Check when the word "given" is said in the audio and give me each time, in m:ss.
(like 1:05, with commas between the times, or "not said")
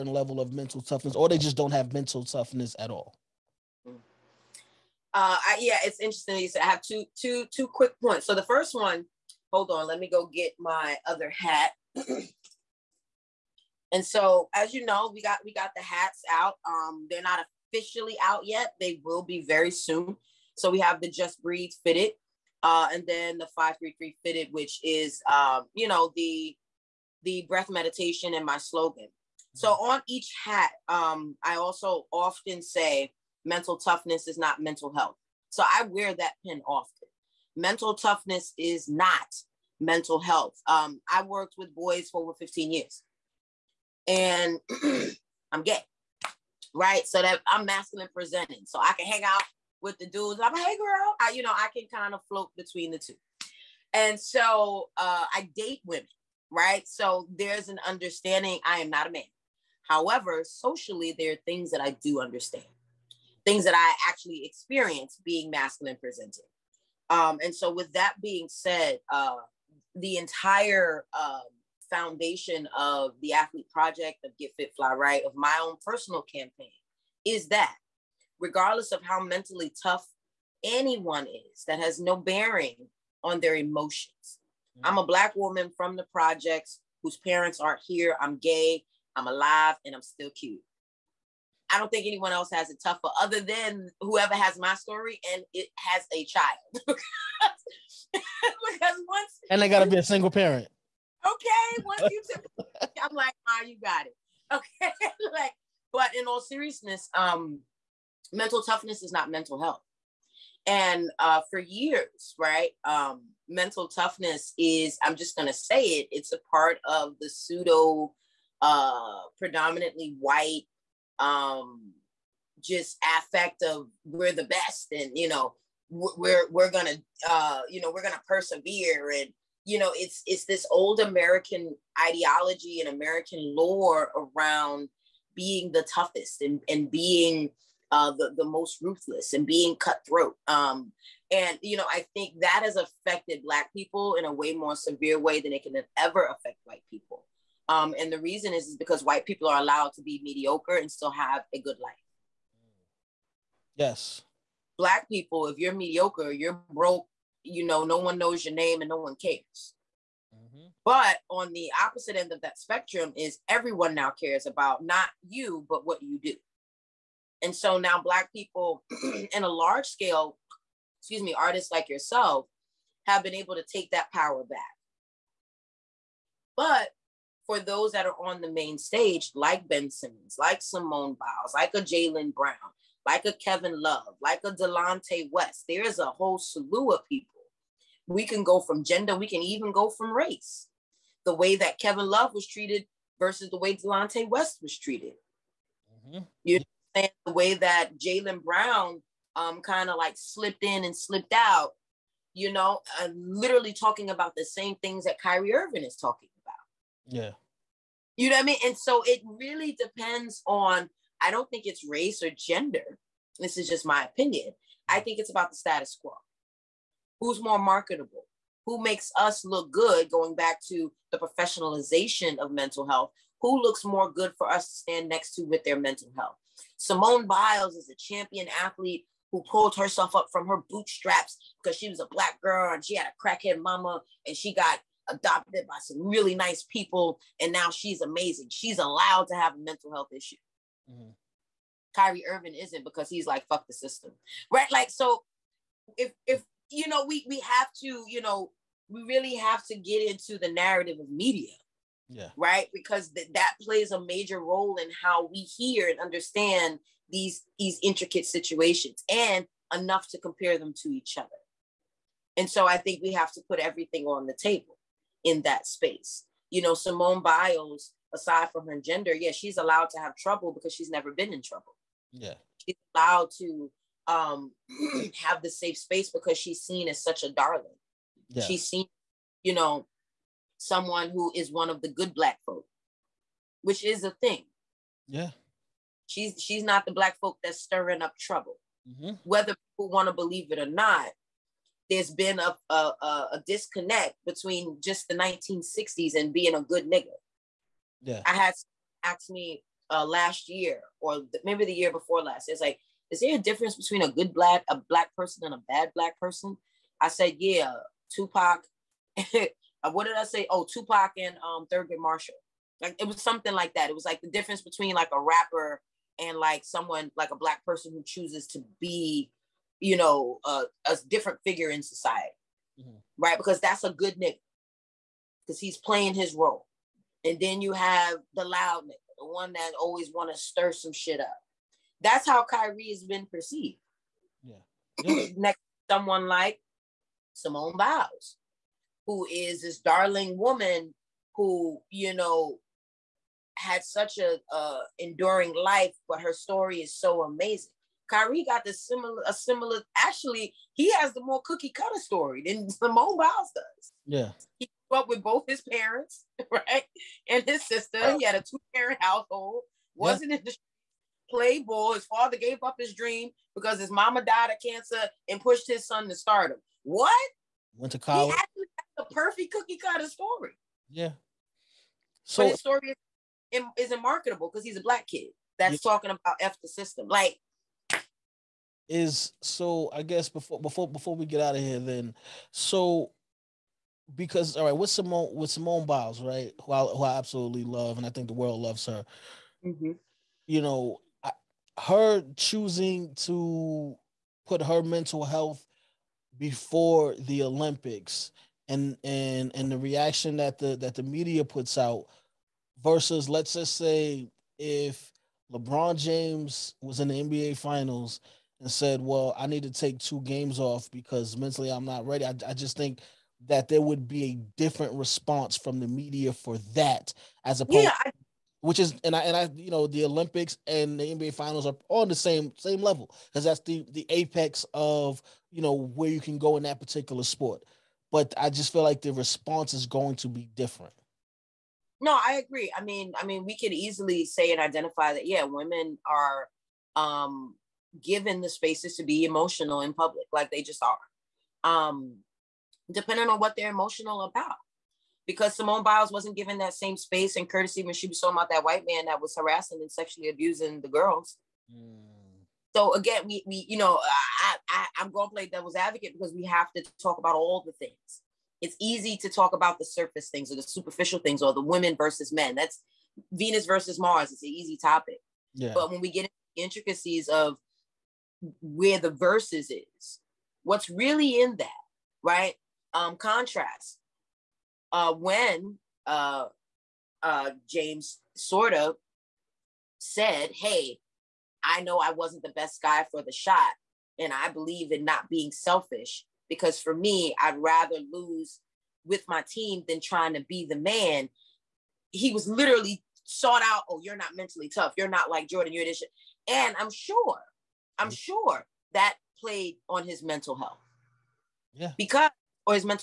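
7:18, 7:26.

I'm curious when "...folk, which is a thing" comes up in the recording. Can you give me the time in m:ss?
4:42.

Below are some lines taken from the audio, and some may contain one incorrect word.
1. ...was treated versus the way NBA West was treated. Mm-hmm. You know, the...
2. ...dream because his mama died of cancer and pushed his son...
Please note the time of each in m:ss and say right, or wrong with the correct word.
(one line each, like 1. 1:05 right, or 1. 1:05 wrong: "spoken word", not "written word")
1. 3:12 wrong: "Delonte", not "NBA"
2. 6:02 right.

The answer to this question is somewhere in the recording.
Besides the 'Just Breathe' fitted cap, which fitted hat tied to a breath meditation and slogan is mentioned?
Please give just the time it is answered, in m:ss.
0:23.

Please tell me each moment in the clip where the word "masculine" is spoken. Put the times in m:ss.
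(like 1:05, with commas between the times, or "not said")
0:47, 1:05.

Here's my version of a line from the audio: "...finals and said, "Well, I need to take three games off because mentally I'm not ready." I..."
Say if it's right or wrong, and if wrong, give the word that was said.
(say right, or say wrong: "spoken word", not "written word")
wrong: "two", not "three".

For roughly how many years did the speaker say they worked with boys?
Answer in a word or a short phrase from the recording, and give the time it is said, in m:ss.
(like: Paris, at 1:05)
15, at 0:42.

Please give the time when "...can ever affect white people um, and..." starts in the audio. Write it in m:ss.
2:25.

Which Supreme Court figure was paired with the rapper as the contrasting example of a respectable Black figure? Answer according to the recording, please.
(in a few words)
Thurgood Marshall.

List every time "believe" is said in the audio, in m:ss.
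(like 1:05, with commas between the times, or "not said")
4:50, 8:04.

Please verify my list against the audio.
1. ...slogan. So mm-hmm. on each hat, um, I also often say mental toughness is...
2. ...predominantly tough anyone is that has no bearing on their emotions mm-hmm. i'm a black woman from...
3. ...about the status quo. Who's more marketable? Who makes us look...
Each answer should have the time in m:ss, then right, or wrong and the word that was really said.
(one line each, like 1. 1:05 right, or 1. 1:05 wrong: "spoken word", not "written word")
1. 0:28 right
2. 1:19 wrong: "mentally", not "predominantly"
3. 3:35 right.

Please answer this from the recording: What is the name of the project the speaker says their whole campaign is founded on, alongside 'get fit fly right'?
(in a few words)
the athlete project.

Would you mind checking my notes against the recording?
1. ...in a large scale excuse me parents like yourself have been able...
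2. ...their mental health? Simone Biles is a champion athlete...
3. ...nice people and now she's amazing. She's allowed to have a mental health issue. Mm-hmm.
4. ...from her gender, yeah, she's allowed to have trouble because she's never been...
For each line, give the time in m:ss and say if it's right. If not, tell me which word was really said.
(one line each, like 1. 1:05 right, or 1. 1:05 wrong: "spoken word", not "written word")
1. 2:49 wrong: "artists", not "parents"
2. 3:45 right
3. 3:56 right
4. 4:28 right.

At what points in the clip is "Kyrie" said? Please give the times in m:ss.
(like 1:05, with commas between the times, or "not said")
3:25, 4:01, 5:32, 5:48.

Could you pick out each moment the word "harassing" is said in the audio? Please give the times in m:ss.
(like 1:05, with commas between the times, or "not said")
7:29.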